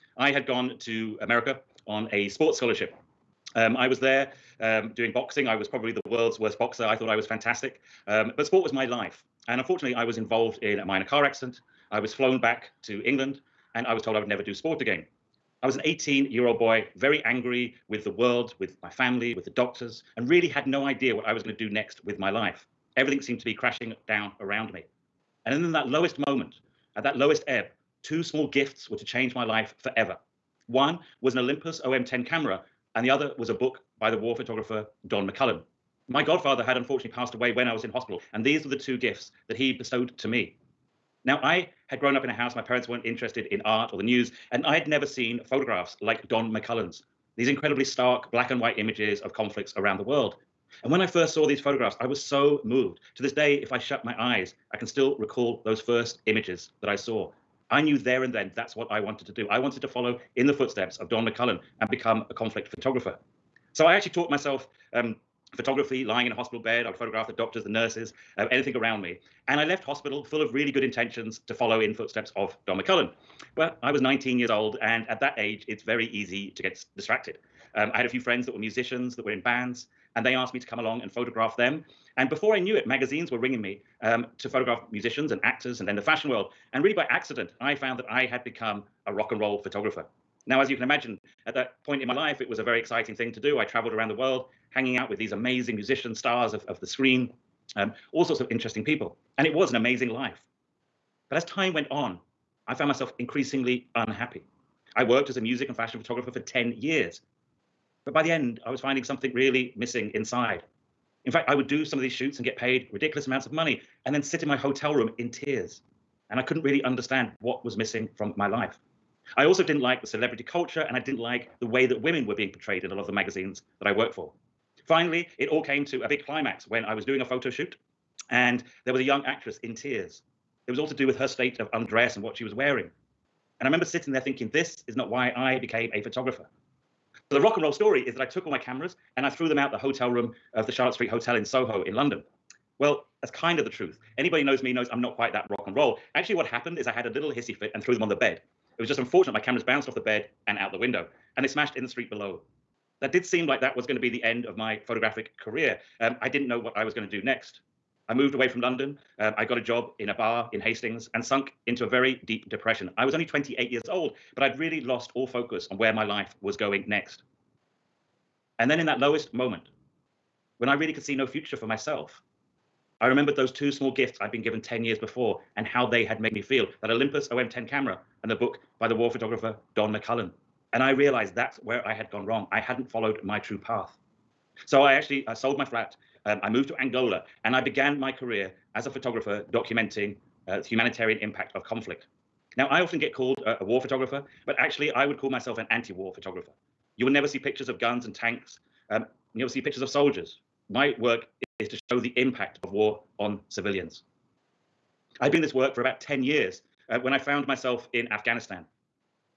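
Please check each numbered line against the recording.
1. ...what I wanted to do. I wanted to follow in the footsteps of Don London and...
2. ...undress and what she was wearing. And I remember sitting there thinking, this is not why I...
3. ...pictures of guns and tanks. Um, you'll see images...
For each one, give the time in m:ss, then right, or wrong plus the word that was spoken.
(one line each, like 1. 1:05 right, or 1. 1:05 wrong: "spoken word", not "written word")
1. 0:58 wrong: "McCullin", not "London"
2. 2:11 right
3. 3:17 wrong: "pictures", not "images".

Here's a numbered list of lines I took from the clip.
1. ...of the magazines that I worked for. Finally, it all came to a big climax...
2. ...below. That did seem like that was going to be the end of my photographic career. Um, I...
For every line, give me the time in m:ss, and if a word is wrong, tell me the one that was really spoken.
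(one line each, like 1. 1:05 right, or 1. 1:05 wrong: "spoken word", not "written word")
1. 2:03 right
2. 2:32 right.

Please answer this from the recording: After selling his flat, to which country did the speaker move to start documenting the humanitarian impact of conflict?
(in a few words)
Angola.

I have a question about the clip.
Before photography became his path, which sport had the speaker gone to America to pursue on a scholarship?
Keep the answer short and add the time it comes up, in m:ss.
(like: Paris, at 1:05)
Boxing, at 0:05.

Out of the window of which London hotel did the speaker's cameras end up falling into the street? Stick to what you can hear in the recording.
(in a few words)
Charlotte Street Hotel.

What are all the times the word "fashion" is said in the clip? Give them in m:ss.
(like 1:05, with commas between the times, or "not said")
1:26, 1:45.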